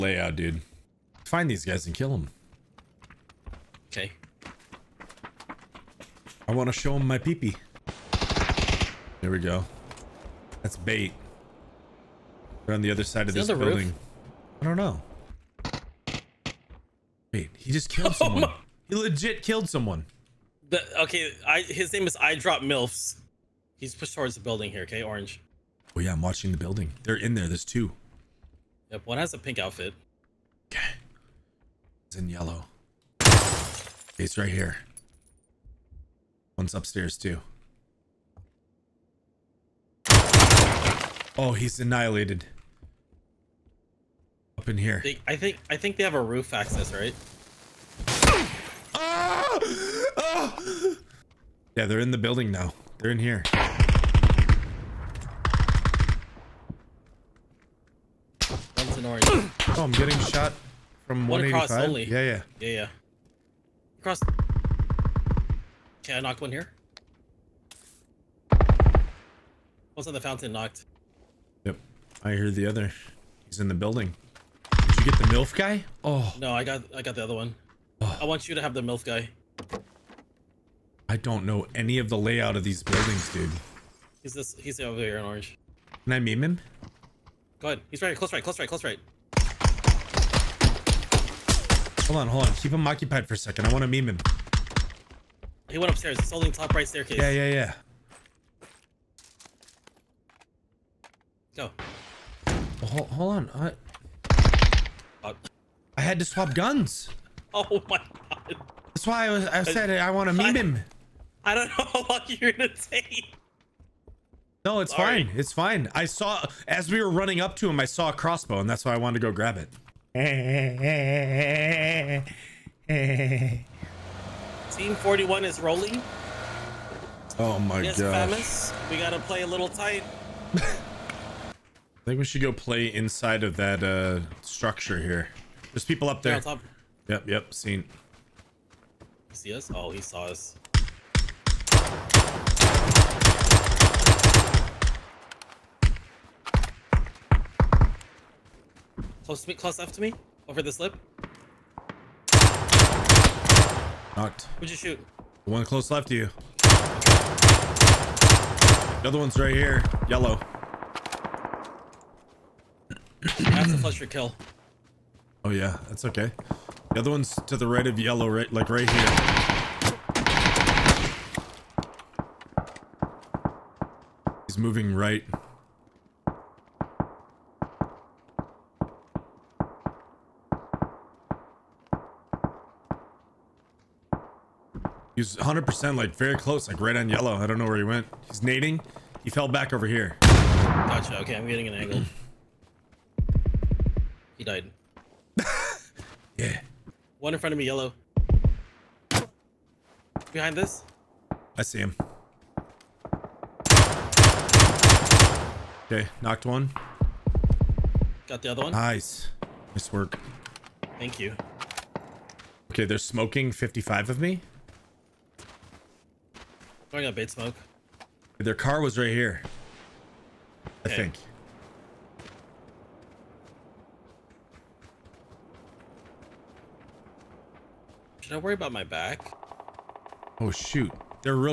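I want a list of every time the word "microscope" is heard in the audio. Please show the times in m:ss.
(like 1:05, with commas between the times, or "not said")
not said.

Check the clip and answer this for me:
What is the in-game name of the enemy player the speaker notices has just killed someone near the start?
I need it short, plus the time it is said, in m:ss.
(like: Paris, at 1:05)
Eyedrop Drop Milfs, at 0:22.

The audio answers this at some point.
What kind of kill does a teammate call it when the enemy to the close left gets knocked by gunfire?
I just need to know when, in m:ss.
2:43.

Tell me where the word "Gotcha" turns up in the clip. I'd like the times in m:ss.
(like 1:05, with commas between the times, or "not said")
3:10.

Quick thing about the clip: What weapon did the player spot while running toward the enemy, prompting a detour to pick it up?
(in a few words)
crossbow.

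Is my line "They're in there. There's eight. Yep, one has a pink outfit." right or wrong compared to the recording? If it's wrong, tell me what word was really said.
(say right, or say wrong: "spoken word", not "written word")
wrong: "two", not "eight".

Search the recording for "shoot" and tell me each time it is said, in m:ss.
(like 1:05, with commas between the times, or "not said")
2:34, 3:50.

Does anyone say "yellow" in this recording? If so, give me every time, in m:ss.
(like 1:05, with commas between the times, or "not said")
0:32, 2:40, 2:47, 3:07, 3:17.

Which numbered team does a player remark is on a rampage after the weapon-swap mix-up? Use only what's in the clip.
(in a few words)
41.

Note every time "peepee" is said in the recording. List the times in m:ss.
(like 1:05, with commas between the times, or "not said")
0:07.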